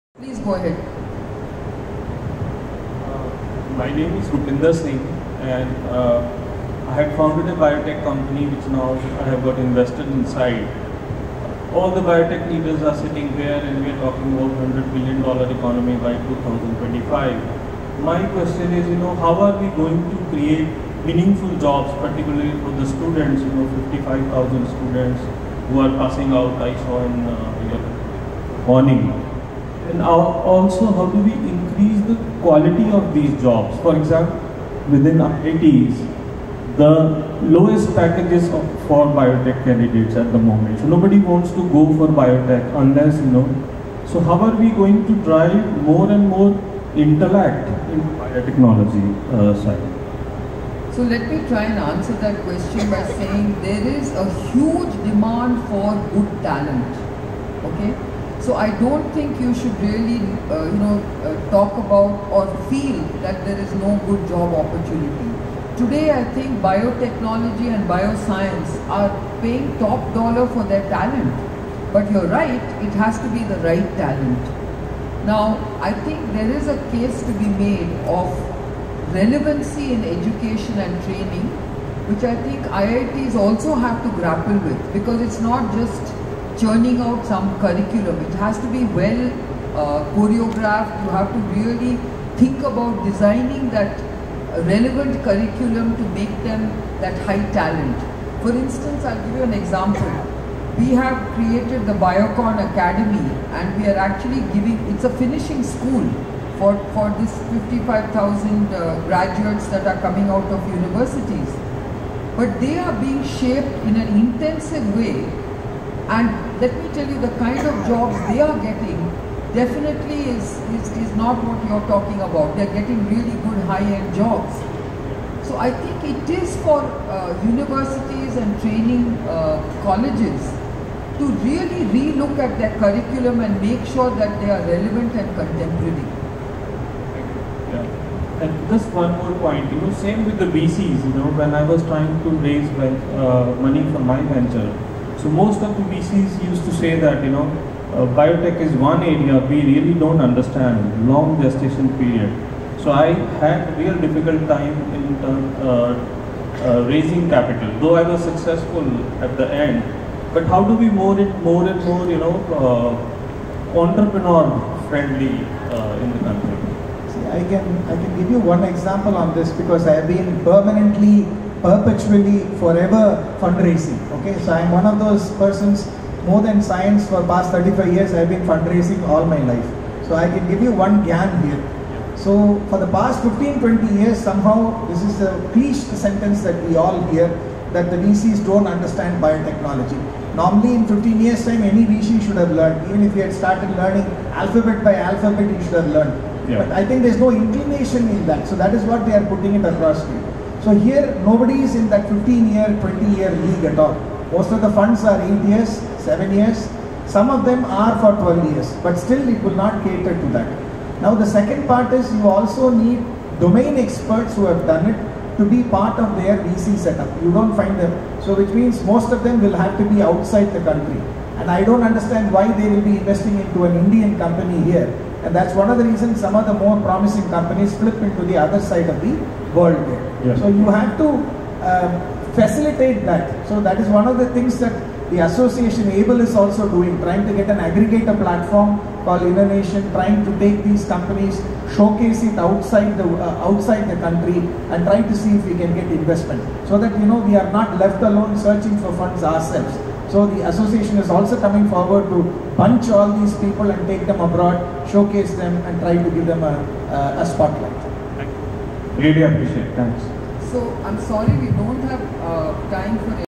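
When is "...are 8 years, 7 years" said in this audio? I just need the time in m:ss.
3:25.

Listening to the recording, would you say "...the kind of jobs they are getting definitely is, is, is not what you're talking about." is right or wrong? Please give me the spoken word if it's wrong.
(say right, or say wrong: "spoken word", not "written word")
right.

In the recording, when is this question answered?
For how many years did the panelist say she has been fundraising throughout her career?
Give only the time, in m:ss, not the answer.
2:57.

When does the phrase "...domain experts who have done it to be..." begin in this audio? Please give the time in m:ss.
3:33.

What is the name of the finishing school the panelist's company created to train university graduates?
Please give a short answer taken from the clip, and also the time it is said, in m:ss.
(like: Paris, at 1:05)
Biocon Academy, at 1:41.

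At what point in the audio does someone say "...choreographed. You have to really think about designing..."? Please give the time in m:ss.
1:30.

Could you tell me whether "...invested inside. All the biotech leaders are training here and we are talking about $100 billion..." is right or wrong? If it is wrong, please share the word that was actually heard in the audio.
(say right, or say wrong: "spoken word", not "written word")
wrong: "sitting", not "training".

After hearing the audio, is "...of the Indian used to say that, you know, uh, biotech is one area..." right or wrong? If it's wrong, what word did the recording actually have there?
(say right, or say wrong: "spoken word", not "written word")
wrong: "VCs", not "Indian".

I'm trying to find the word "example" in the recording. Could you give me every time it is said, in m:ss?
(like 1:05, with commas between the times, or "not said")
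0:33, 1:39, 2:48.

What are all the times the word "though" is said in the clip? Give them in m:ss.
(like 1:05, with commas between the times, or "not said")
2:37.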